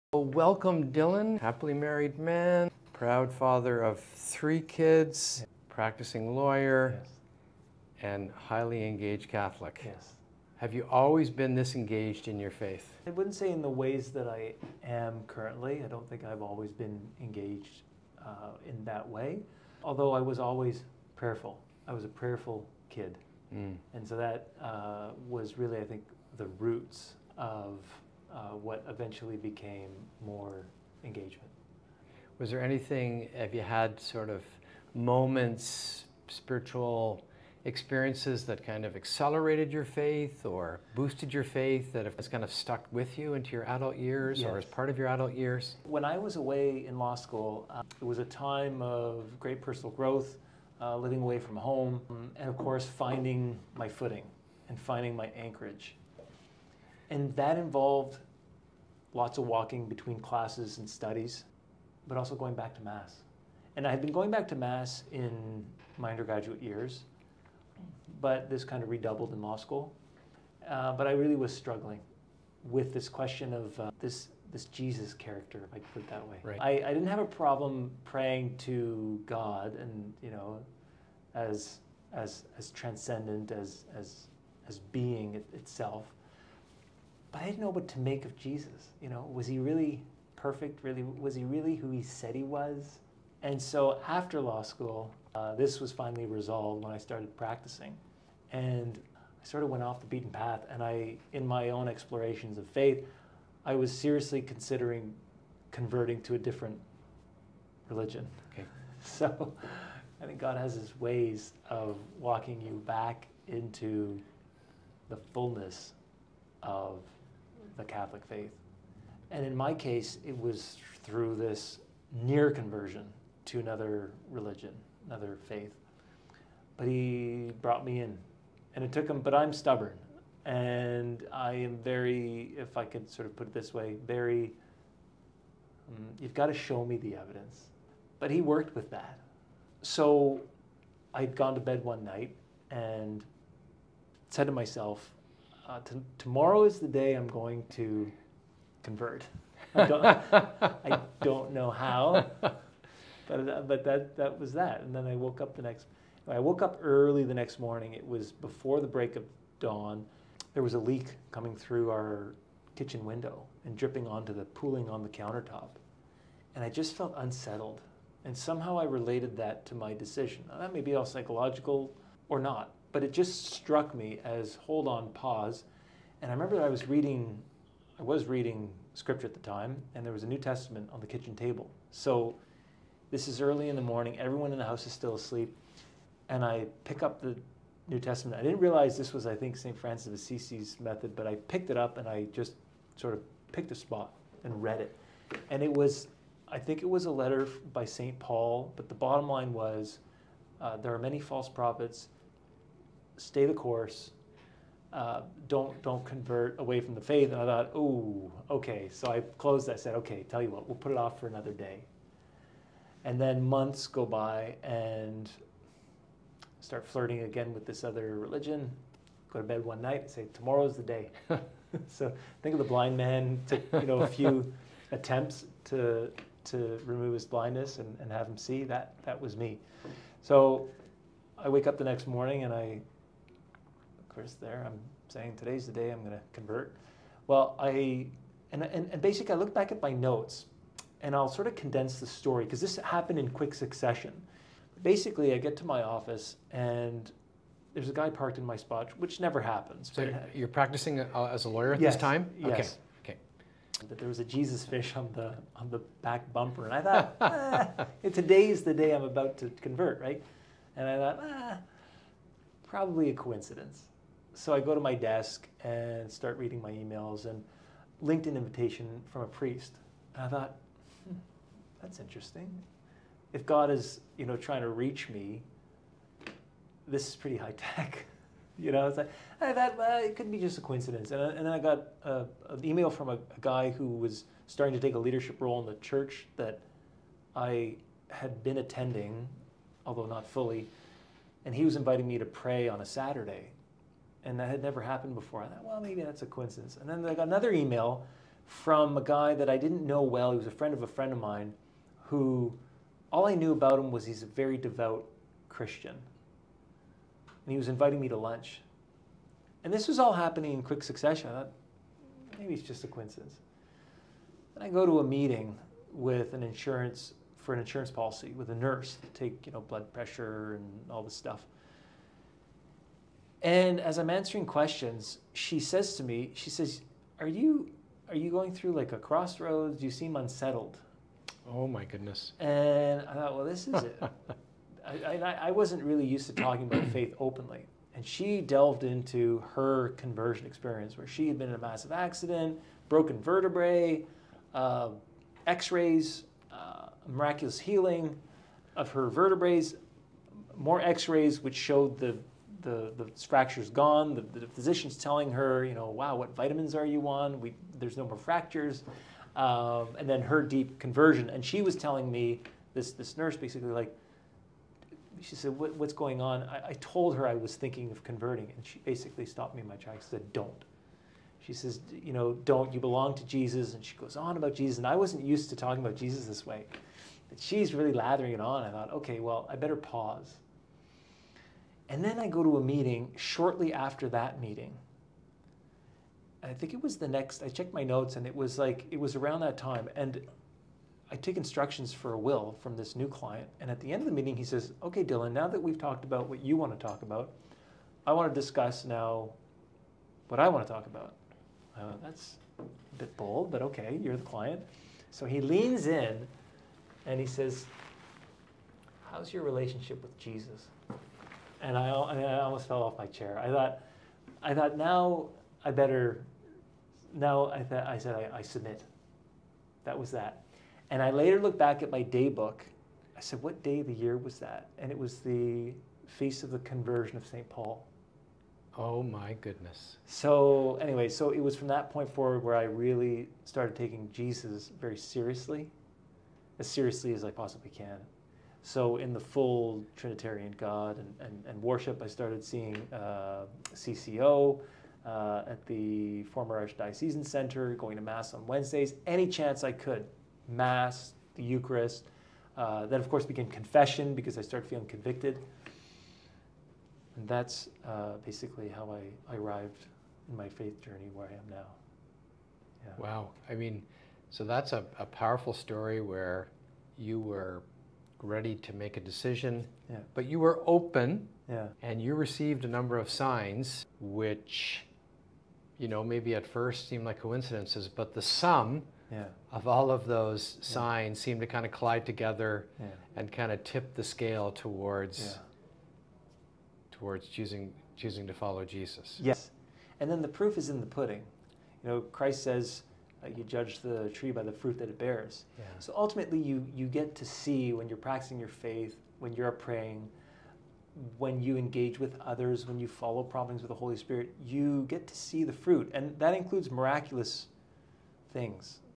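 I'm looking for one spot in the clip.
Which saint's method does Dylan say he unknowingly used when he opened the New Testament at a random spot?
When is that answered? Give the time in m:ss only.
3:09.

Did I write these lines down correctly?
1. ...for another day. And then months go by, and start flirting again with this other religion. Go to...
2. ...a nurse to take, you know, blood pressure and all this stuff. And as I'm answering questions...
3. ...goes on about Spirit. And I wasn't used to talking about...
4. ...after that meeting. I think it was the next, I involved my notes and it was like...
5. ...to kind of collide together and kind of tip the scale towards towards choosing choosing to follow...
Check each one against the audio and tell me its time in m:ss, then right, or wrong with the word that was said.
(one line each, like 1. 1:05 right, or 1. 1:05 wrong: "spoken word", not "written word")
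1. 3:31 right
2. 5:18 right
3. 6:13 wrong: "Jesus", not "Spirit"
4. 6:23 wrong: "checked", not "involved"
5. 8:01 right.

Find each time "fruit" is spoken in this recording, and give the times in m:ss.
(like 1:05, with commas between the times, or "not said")
8:14, 8:25.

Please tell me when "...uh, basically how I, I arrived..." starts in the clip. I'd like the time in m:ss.
7:37.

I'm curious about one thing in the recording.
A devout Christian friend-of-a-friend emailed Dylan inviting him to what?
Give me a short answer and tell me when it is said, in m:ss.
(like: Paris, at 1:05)
Lunch, at 5:08.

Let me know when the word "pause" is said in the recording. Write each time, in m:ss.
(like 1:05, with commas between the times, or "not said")
2:55, 6:19.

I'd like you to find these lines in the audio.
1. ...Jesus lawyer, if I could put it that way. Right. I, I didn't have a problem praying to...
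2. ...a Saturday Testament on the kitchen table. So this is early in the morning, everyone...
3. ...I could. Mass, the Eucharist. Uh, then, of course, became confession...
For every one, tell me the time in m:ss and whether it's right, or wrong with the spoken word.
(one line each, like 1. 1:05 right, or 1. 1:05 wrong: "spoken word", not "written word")
1. 1:14 wrong: "character", not "lawyer"
2. 3:00 wrong: "New", not "Saturday"
3. 7:29 right.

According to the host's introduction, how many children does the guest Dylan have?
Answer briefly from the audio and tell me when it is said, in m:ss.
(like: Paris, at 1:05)
3, at 0:04.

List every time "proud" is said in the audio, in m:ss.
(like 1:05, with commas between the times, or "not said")
0:02.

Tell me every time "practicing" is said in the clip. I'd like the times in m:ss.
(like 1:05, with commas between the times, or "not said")
0:05, 1:37, 4:10, 8:17.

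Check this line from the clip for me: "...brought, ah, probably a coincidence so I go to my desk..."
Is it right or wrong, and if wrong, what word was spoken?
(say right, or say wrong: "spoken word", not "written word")
wrong: "thought", not "brought".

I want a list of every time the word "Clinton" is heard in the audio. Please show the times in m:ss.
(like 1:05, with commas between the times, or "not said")
not said.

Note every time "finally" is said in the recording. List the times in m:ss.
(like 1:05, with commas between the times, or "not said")
1:35.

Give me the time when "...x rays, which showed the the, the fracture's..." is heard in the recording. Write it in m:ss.
5:50.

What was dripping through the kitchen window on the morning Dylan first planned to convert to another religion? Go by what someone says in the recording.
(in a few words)
A leak.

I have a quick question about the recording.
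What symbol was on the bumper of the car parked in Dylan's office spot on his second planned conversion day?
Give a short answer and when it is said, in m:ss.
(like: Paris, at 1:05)
A Jesus fish, at 4:14.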